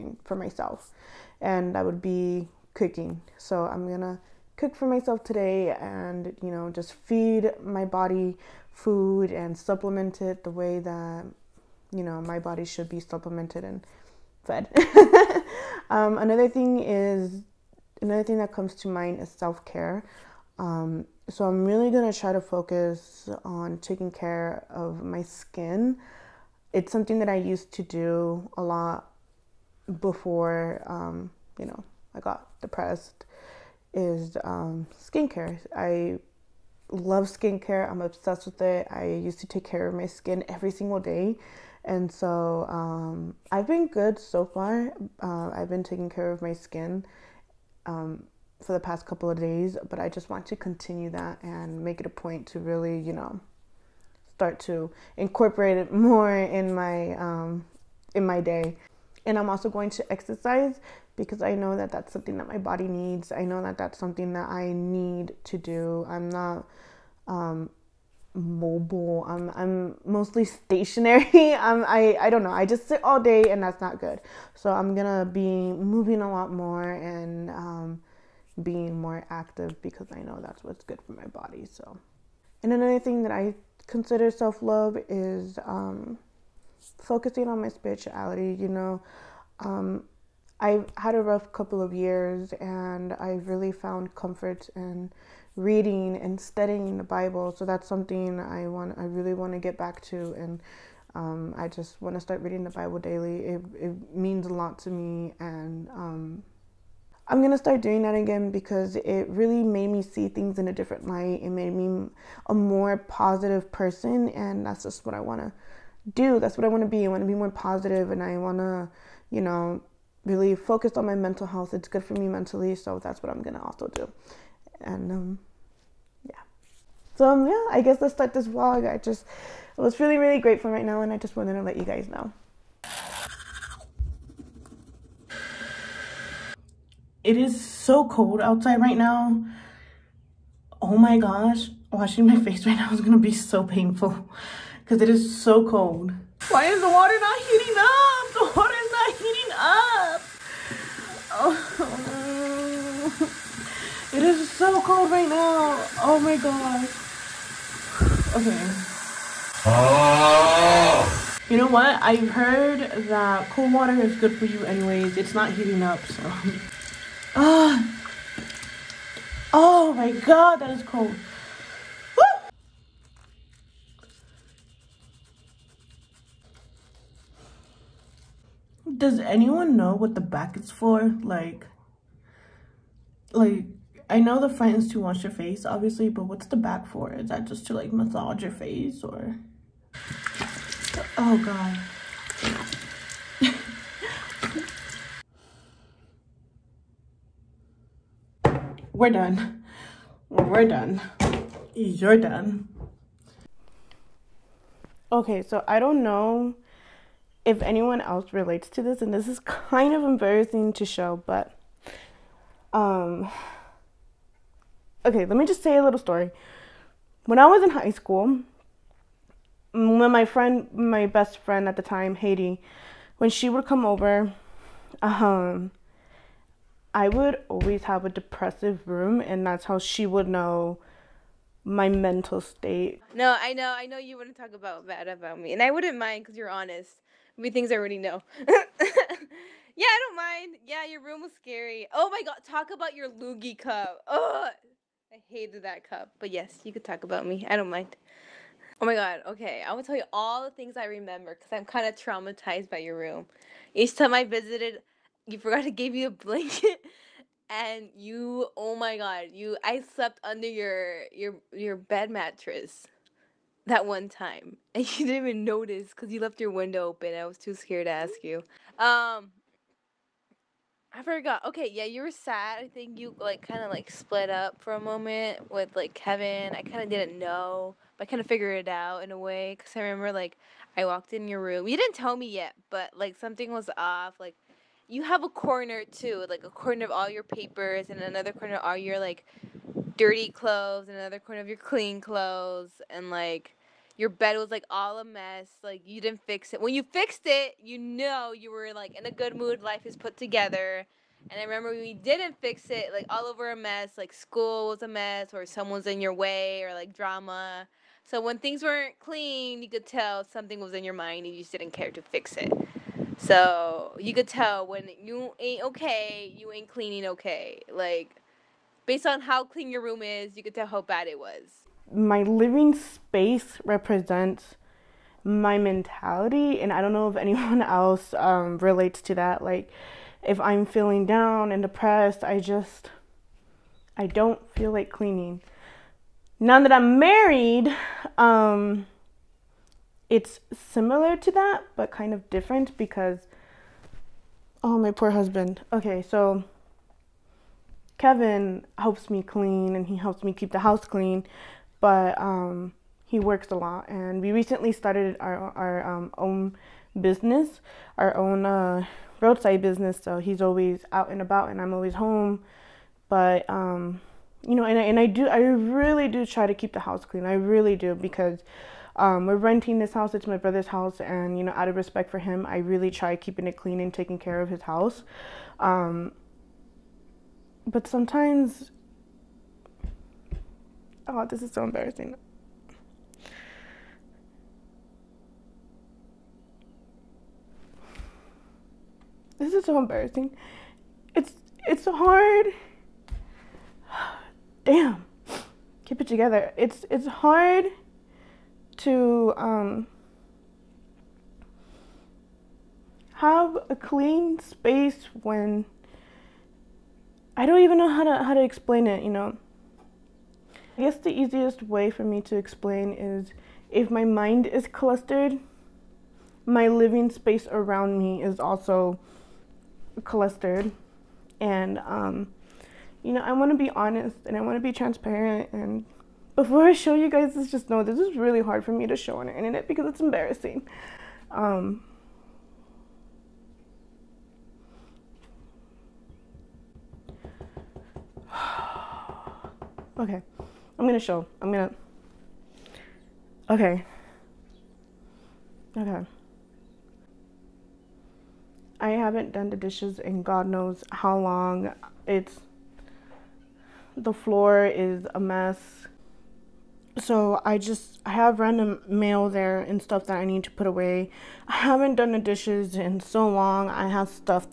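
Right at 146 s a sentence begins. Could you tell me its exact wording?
Why is the water not heating up?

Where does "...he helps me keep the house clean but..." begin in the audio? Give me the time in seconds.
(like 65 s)
349 s.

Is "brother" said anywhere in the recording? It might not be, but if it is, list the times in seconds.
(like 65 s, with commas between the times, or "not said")
370 s.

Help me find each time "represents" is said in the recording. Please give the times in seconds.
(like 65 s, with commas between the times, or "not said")
323 s.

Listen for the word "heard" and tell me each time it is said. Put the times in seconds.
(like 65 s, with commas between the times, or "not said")
162 s.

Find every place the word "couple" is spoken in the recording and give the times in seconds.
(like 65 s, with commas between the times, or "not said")
49 s, 91 s.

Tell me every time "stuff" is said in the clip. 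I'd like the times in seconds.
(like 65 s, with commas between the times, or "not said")
459 s.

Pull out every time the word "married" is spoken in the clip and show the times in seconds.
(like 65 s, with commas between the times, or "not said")
336 s.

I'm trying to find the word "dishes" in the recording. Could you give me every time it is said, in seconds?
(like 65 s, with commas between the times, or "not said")
449 s, 462 s.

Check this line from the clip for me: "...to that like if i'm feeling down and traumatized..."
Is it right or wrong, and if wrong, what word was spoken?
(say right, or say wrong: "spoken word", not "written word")
wrong: "depressed", not "traumatized".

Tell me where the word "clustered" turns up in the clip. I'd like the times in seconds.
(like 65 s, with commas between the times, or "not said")
414 s, 420 s.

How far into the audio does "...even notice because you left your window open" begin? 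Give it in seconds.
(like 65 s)
265 s.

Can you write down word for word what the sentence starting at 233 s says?
No, I know, I know you wouldn't talk about bad about me, and I wouldn't mind because you're honest.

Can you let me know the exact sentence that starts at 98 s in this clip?
I really want to get back to, and um, I just want to start reading the Bible daily.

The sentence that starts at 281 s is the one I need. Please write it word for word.
You didn't tell me yet, but like something was off.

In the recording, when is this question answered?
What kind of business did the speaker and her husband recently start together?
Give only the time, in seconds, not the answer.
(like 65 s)
359 s.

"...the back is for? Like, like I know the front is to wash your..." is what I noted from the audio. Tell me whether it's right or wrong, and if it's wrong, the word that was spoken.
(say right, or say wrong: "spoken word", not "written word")
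right.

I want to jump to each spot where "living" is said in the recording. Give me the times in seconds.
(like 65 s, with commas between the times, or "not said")
322 s, 416 s.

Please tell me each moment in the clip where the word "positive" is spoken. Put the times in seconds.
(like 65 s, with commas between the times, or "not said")
112 s, 117 s.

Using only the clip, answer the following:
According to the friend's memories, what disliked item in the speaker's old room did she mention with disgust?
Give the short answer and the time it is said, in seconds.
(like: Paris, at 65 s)
Loogie cup, at 243 s.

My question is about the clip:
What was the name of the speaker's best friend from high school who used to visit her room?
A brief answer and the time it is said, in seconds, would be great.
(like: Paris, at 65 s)
Haiti, at 222 s.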